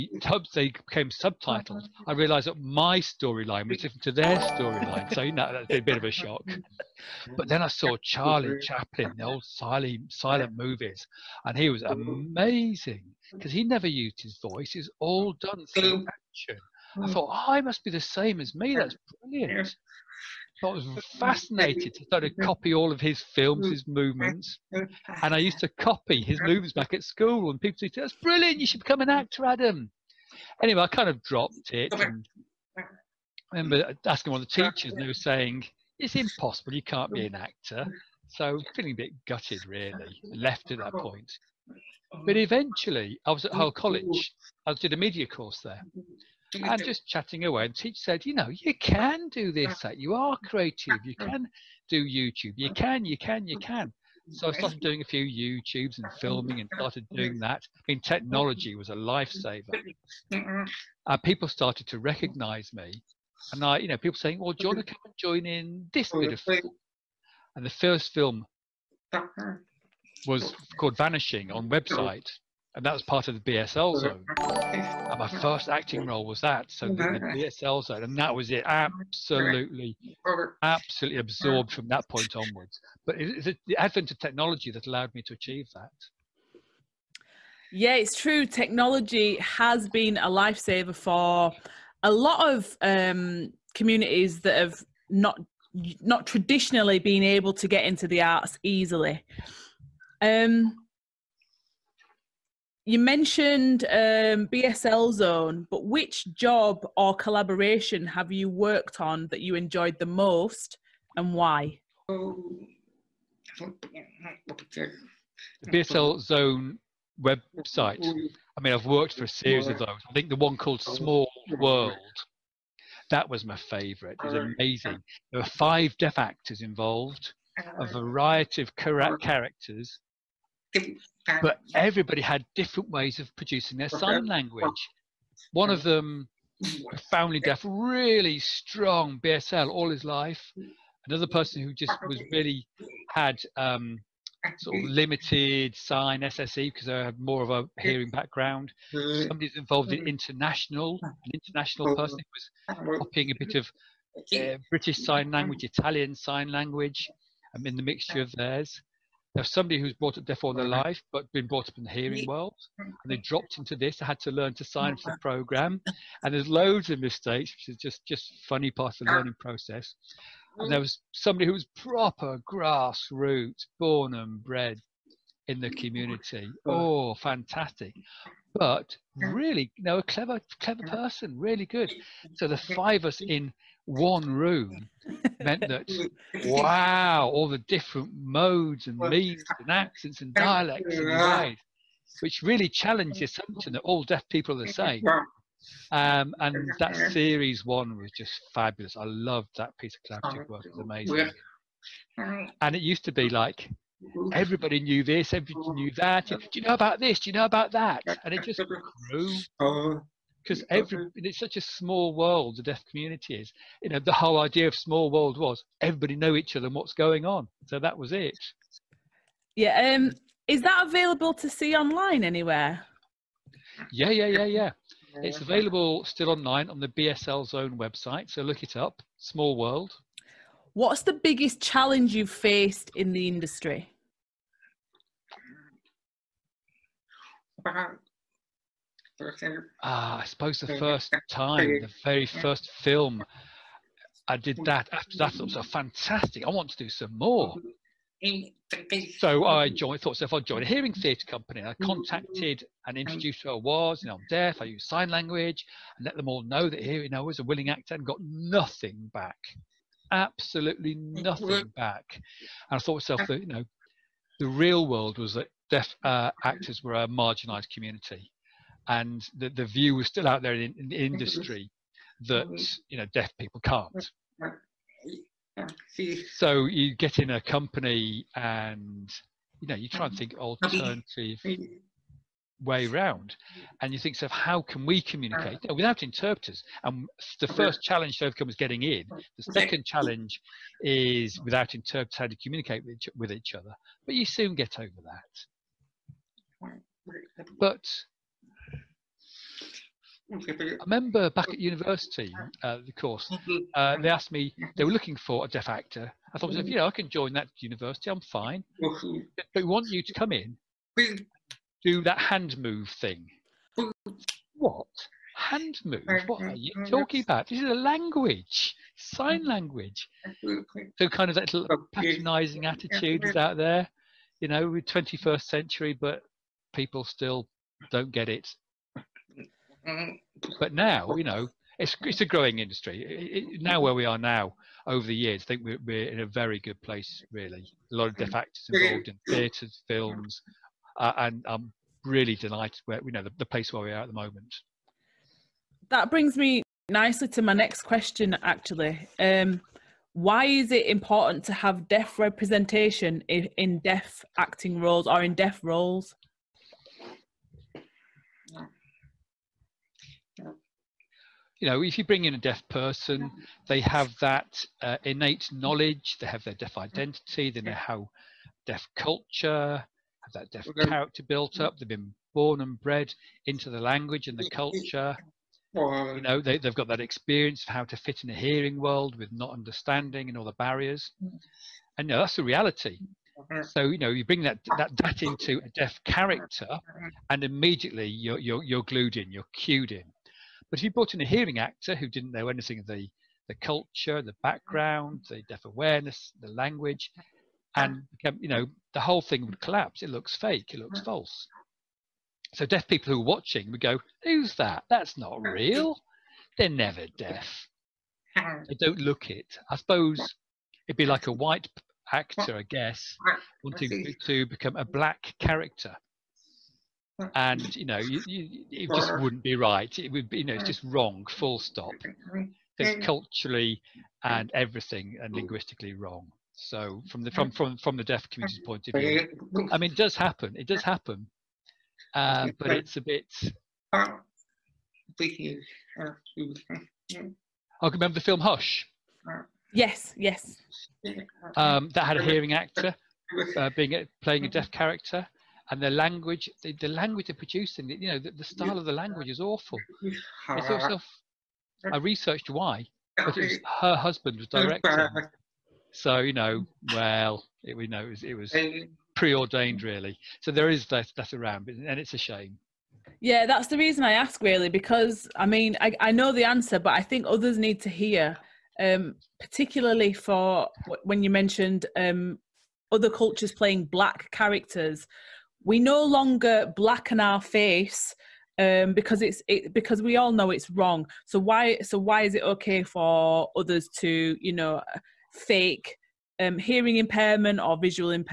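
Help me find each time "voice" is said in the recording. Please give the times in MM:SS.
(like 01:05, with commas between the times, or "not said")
00:14.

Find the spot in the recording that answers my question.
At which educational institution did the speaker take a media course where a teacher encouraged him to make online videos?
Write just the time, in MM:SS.
00:43.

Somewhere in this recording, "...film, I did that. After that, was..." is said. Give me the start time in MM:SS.
04:02.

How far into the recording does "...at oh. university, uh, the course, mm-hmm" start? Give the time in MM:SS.
05:01.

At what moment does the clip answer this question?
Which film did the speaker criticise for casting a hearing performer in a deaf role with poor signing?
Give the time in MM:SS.
07:18.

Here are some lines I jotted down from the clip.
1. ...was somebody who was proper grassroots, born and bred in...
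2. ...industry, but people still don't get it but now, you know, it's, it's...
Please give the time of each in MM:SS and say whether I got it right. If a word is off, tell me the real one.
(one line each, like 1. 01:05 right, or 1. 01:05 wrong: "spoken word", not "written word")
1. 02:50 right
2. 05:25 wrong: "century", not "industry".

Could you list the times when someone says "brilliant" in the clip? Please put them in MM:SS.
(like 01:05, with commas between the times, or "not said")
00:19, 00:28.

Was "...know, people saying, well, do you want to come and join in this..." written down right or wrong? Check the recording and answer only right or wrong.
right.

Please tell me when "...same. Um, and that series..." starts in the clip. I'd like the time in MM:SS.
03:14.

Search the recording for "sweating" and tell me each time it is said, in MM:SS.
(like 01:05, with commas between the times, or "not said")
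not said.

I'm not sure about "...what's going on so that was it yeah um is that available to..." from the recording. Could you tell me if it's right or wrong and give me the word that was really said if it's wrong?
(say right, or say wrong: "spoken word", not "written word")
right.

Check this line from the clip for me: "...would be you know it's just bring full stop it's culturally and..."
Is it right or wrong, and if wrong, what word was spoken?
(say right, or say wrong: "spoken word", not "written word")
wrong: "wrong", not "bring".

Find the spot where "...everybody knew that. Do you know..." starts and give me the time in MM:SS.
03:25.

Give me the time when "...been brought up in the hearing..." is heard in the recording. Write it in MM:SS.
02:41.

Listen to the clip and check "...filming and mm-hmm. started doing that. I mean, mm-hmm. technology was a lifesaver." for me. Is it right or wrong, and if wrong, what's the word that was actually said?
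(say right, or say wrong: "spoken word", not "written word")
right.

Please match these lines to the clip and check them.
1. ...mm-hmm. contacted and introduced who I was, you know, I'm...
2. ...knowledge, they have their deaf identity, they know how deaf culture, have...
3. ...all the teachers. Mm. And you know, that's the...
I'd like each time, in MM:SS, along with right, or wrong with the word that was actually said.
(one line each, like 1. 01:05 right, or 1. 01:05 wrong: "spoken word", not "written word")
1. 04:11 right
2. 06:05 right
3. 06:20 wrong: "barriers", not "teachers".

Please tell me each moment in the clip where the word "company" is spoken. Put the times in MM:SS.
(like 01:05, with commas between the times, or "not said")
04:11, 04:37.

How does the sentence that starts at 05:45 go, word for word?
That brings me nicely to my next question, actually.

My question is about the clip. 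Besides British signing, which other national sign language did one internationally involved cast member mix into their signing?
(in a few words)
Italian Sign Language.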